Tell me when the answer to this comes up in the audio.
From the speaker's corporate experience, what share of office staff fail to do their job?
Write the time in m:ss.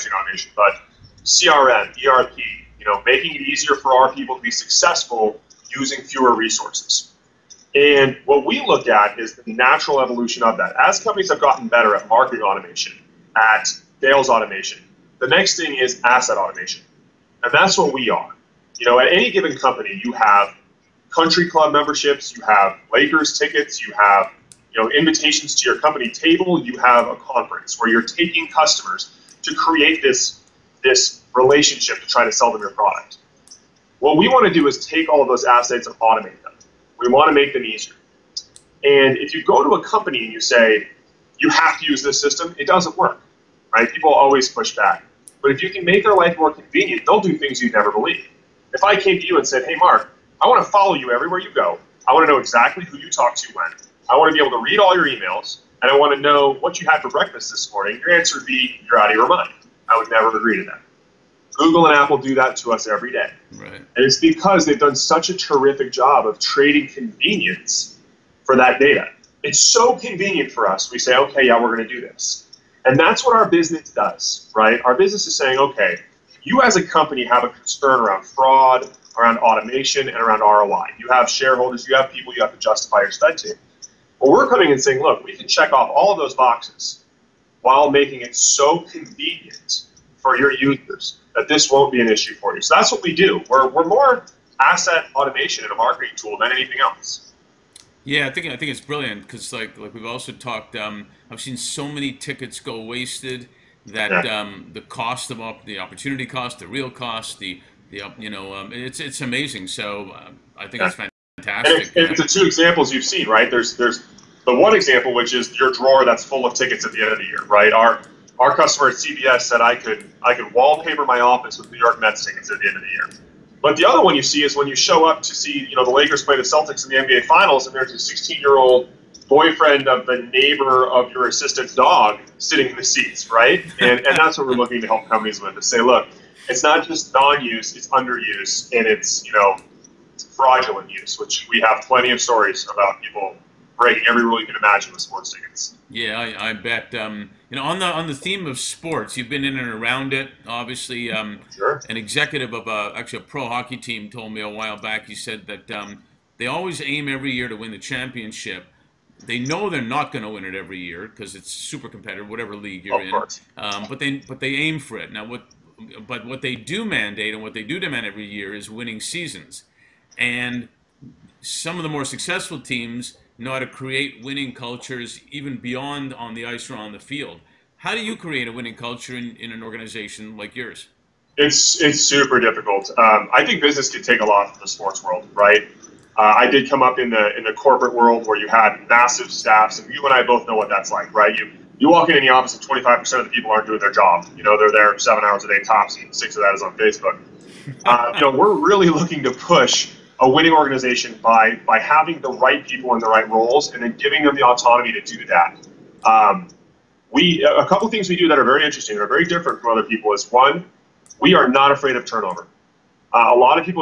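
3:12.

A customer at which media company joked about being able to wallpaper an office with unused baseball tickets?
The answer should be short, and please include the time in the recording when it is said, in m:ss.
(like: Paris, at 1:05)
CBS, at 1:58.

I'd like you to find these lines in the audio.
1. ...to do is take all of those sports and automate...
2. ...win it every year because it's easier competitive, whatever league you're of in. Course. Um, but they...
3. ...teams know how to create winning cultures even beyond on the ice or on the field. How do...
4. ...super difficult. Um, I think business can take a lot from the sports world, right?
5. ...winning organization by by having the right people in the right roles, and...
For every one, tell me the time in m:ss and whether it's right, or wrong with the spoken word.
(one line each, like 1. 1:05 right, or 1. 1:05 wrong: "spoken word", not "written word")
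1. 0:34 wrong: "assets", not "sports"
2. 2:40 wrong: "super", not "easier"
3. 2:52 right
4. 3:02 right
5. 3:20 right.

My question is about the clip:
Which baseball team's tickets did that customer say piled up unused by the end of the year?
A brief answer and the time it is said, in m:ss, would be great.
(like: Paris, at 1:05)
New York Mets, at 2:01.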